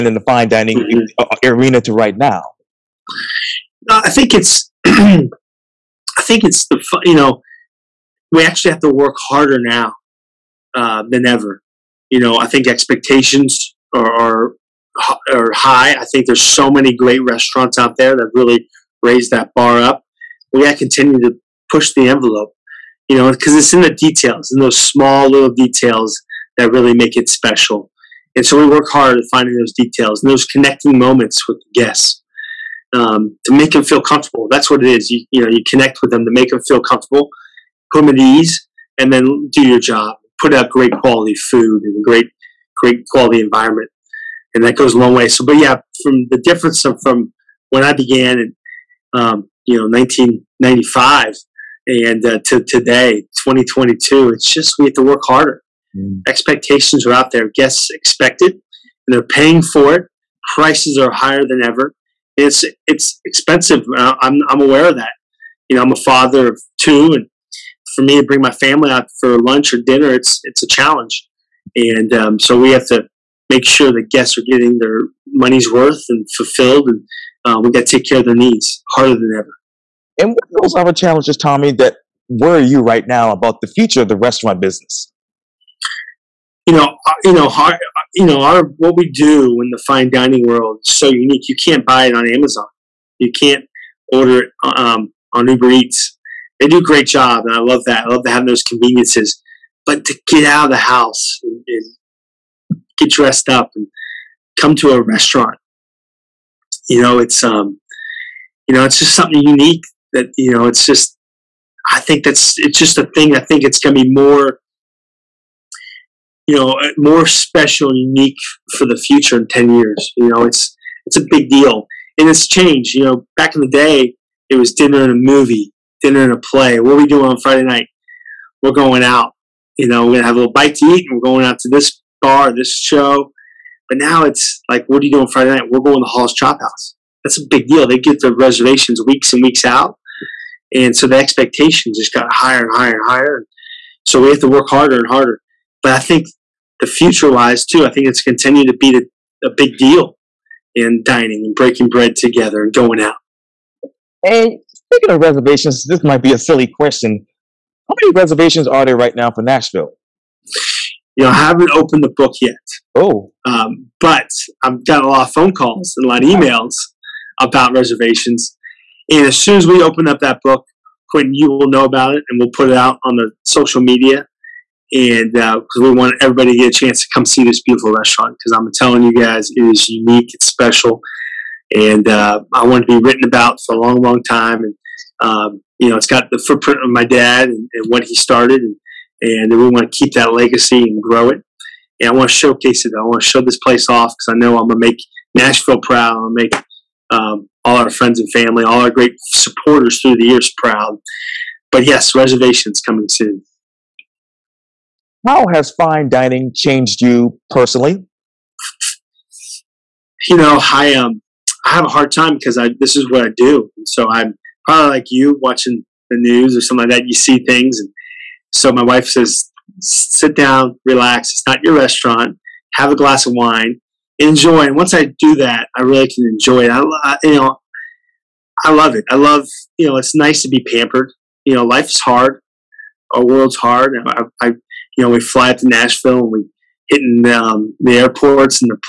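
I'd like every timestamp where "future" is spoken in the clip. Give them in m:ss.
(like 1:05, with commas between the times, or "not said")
1:23, 1:58, 2:26.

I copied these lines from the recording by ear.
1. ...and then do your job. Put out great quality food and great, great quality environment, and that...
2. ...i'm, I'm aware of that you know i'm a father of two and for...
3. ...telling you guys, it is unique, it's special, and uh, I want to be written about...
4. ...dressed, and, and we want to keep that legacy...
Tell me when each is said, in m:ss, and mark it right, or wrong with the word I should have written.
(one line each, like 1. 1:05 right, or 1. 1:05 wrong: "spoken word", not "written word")
1. 0:38 right
2. 1:04 right
3. 2:58 right
4. 3:08 wrong: "started", not "dressed".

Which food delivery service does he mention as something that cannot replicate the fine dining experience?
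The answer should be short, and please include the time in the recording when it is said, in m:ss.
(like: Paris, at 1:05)
Uber Eats, at 1:35.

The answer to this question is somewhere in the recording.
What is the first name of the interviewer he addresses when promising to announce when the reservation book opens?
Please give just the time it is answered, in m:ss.
2:51.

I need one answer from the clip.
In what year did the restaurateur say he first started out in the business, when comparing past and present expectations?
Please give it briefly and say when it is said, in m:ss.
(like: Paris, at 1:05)
1995, at 0:49.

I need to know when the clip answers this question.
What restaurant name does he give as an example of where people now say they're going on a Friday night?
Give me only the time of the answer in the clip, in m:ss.
2:16.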